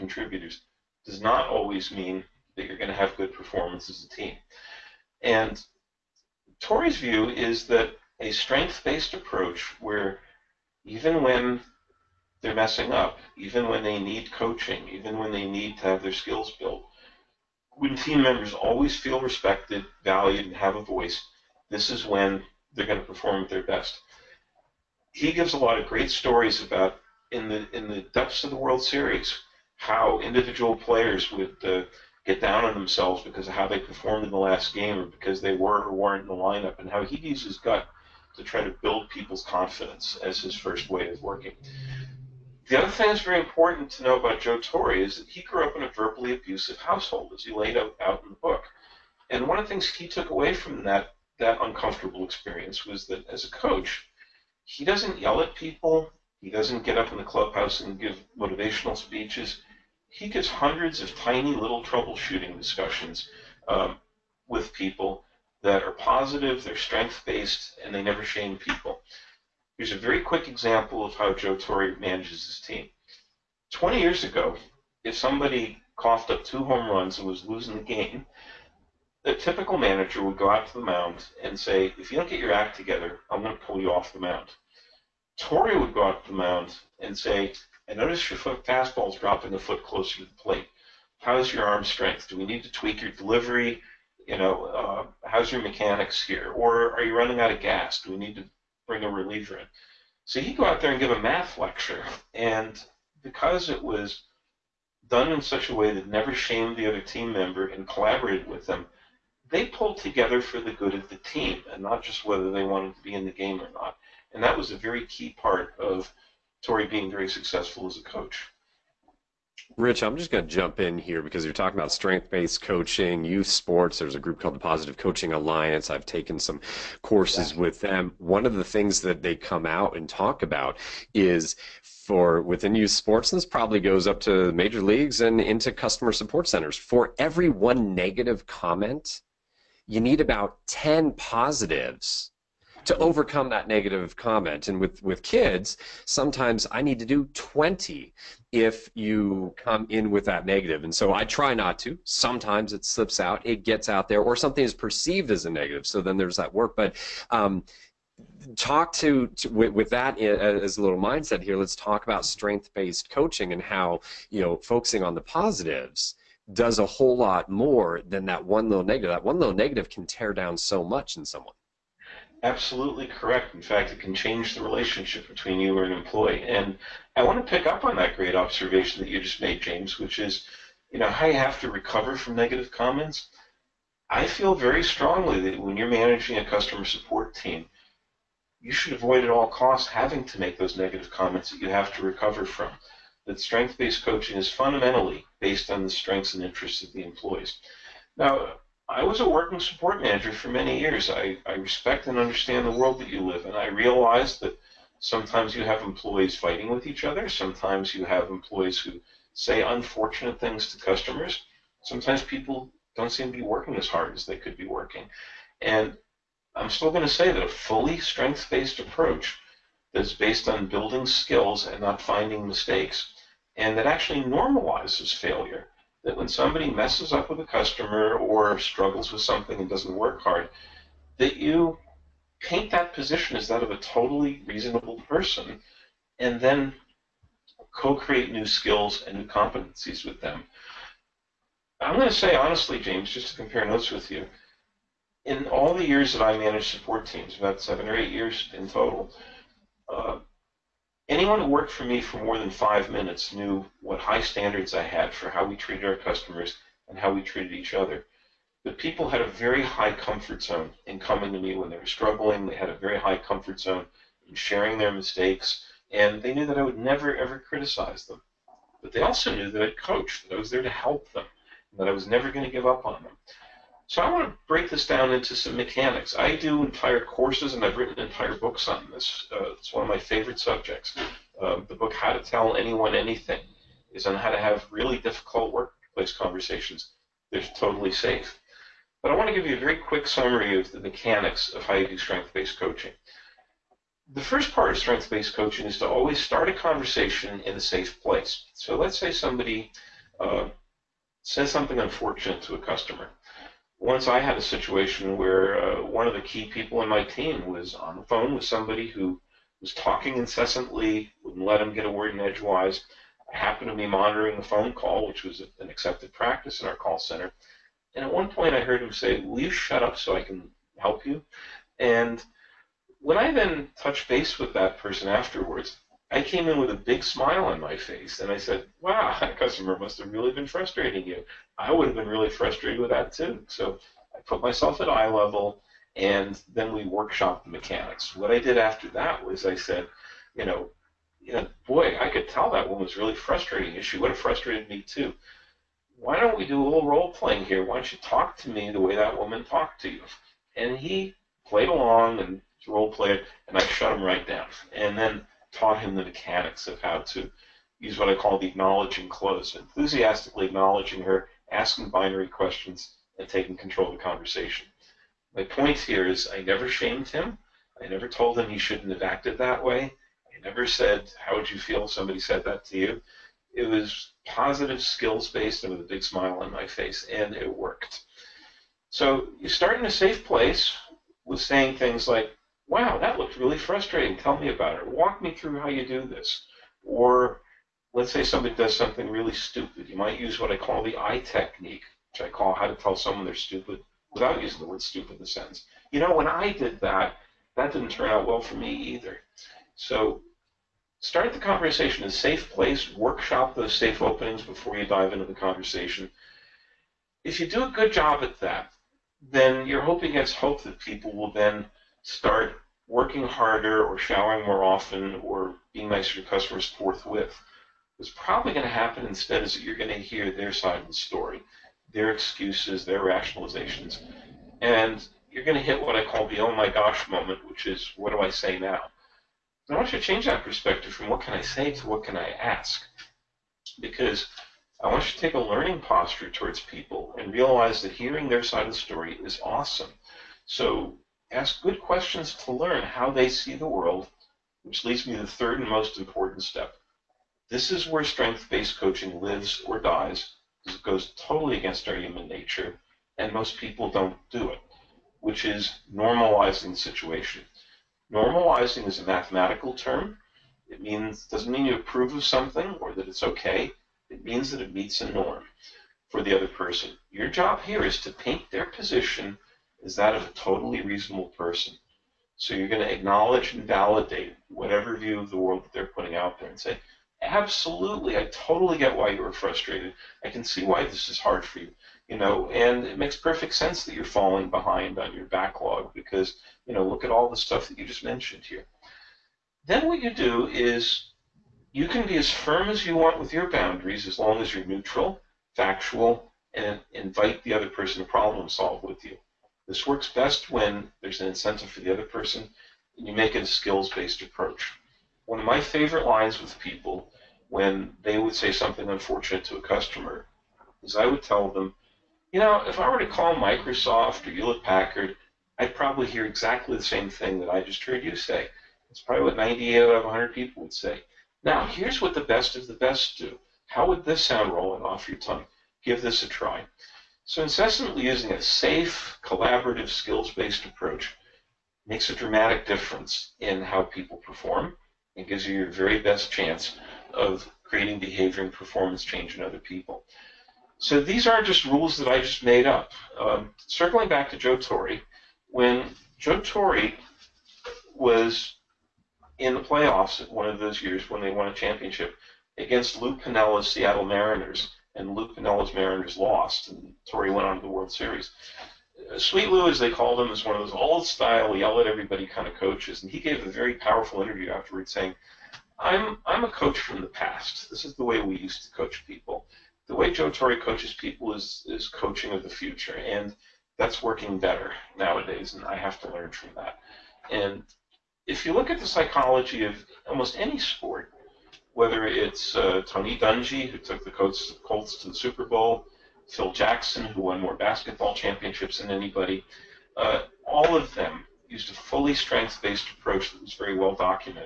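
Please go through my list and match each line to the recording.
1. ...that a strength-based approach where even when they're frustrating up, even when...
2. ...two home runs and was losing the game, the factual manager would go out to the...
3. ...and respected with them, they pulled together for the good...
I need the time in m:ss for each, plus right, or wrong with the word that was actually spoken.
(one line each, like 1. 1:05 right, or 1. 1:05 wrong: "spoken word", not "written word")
1. 0:07 wrong: "messing", not "frustrating"
2. 1:16 wrong: "typical", not "factual"
3. 1:47 wrong: "collaborated", not "respected".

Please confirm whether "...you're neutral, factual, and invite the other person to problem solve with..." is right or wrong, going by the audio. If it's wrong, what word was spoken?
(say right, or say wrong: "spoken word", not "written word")
right.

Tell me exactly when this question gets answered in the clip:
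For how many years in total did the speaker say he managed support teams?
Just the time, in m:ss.
4:07.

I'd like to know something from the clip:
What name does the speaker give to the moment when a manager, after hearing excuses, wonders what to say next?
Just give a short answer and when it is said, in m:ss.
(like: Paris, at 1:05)
oh my gosh moment, at 7:06.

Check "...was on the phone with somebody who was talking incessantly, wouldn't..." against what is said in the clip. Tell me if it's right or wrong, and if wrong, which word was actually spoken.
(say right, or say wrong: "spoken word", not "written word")
right.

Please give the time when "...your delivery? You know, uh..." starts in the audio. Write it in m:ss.
1:33.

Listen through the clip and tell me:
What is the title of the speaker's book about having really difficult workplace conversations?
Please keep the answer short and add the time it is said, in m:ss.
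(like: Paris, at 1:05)
How to Tell Anyone Anything, at 4:41.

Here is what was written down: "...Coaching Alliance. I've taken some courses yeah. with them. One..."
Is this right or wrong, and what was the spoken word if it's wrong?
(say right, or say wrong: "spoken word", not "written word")
right.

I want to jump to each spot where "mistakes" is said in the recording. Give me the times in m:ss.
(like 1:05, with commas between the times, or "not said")
3:42, 4:24.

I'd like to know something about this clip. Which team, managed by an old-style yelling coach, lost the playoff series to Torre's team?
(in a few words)
Seattle Mariners.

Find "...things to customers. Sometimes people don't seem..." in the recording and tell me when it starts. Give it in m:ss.
3:30.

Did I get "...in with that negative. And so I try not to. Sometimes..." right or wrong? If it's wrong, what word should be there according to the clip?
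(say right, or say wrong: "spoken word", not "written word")
right.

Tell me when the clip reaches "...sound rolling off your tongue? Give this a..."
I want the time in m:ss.
8:44.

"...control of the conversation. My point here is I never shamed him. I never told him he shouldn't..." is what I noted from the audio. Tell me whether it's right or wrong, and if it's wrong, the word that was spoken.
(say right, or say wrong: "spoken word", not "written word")
right.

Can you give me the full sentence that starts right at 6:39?
So start the conversation in a safe place, workshop those safe openings before you dive into the conversation.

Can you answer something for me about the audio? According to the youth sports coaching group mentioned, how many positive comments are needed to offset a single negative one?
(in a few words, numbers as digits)
10.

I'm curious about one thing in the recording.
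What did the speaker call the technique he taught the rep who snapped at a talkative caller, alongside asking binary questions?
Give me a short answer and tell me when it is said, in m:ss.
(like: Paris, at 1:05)
acknowledging close, at 5:58.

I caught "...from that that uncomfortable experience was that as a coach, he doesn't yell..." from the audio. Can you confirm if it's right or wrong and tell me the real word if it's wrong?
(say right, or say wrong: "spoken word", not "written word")
right.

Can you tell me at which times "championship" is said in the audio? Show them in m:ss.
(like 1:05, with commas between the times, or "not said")
9:11, 9:48.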